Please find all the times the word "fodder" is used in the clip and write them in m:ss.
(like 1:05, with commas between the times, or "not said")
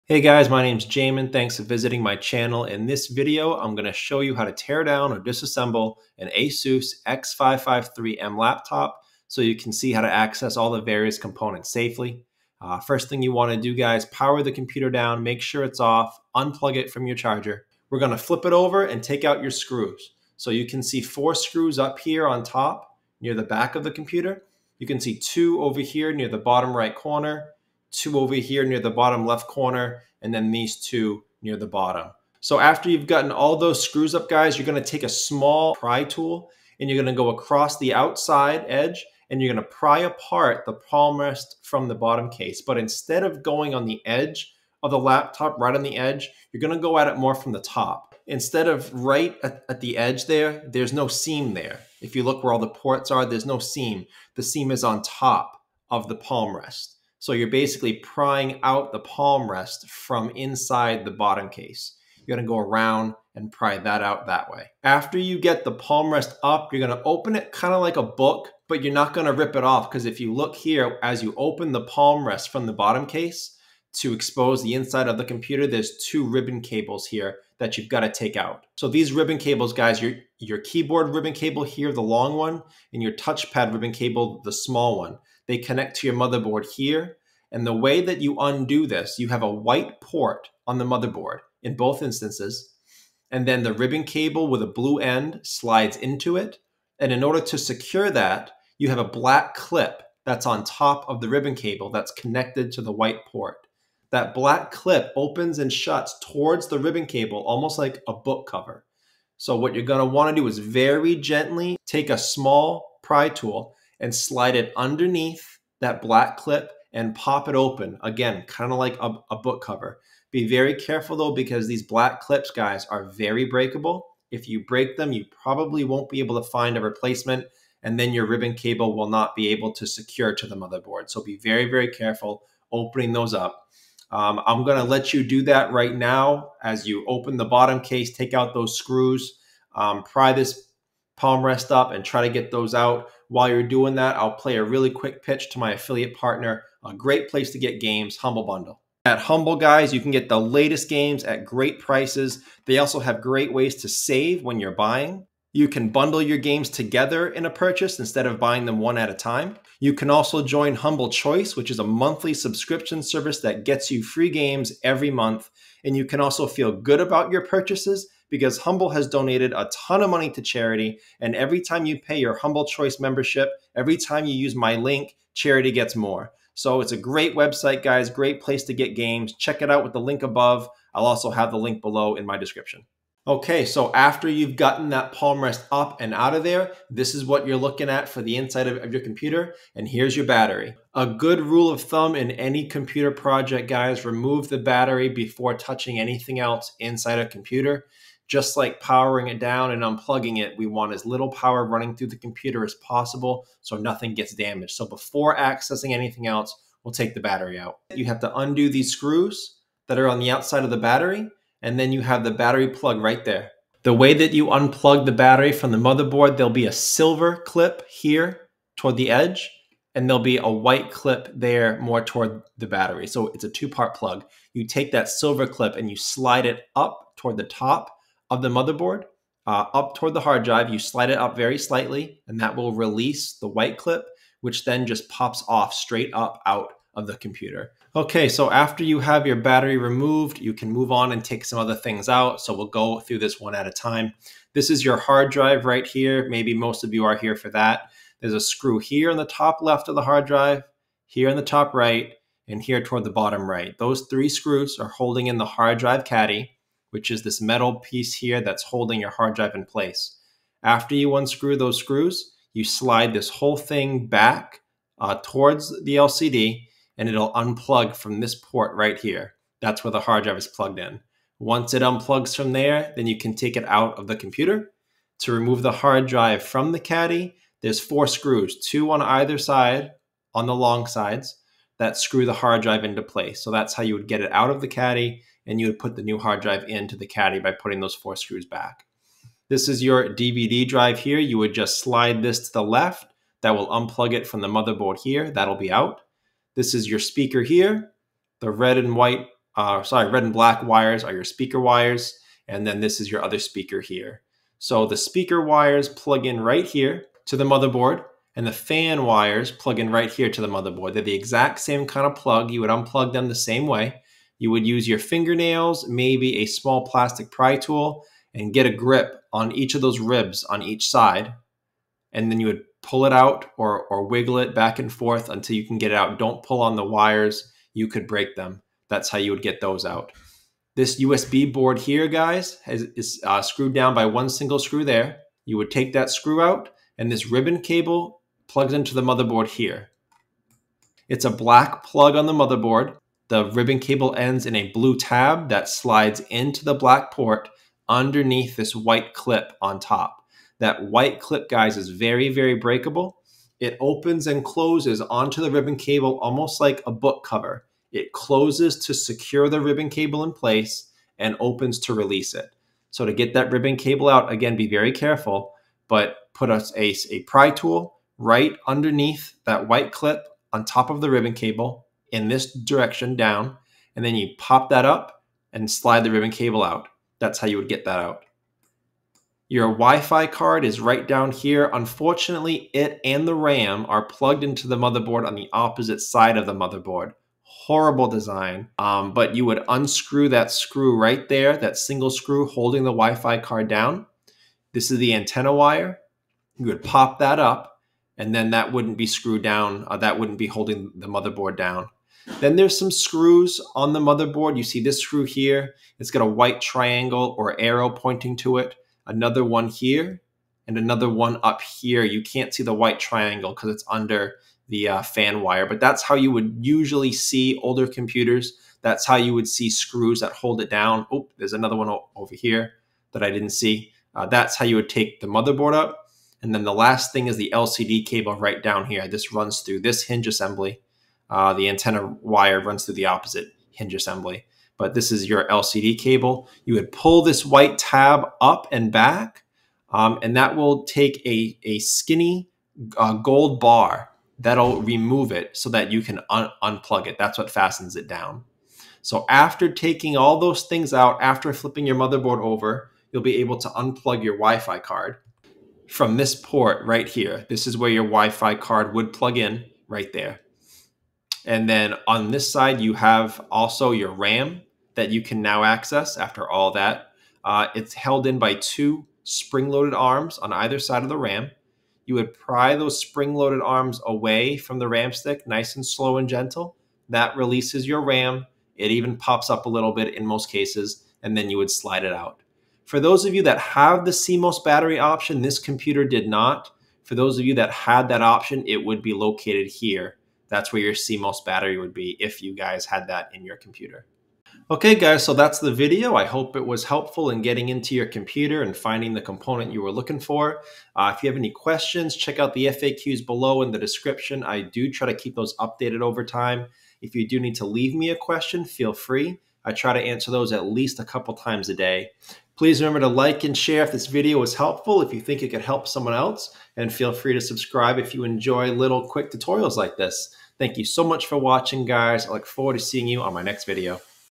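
not said.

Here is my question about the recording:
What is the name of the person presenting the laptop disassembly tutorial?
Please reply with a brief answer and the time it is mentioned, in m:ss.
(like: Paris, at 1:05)
Jamin, at 0:00.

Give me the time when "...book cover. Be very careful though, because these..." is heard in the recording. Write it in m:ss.
1:59.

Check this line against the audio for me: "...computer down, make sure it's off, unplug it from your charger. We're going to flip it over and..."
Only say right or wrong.
right.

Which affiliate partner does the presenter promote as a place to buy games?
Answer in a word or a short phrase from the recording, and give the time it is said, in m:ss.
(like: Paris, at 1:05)
Humble Bundle, at 2:28.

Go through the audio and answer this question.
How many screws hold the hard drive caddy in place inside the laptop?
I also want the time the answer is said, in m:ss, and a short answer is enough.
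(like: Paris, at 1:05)
3, at 4:13.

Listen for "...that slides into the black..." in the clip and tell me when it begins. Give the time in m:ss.
5:45.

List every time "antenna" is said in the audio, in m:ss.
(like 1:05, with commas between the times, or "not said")
6:35, 7:11.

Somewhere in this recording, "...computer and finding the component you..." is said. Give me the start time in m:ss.
8:18.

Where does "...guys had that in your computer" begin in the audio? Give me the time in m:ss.
8:12.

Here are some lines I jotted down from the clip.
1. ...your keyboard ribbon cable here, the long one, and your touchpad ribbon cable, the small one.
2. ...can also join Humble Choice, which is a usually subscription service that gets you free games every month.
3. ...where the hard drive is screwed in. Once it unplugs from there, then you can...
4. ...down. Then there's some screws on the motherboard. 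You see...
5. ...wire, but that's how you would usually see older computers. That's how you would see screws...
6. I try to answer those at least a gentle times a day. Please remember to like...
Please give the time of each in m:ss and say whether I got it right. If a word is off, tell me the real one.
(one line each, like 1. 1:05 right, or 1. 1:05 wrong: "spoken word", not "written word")
1. 1:20 right
2. 2:39 wrong: "monthly", not "usually"
3. 4:29 wrong: "plugged", not "screwed"
4. 6:41 right
5. 6:55 right
6. 8:29 wrong: "couple", not "gentle".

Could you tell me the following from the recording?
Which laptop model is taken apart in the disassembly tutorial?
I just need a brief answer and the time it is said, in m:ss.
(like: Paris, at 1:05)
ASUS X553M, at 0:06.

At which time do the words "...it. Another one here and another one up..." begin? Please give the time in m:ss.
6:48.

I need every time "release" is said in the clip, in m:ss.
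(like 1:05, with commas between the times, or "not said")
3:52, 6:01, 7:57.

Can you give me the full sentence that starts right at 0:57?
So you're basically prying out the palm rest from inside the bottom case.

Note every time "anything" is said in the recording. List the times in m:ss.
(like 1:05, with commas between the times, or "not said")
3:15, 3:25.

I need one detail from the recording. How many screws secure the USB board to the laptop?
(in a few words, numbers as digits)
1.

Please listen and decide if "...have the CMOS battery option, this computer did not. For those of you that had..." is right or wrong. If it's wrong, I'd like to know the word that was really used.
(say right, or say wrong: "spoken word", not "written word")
right.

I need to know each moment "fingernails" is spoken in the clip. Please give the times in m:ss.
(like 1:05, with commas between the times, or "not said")
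5:14.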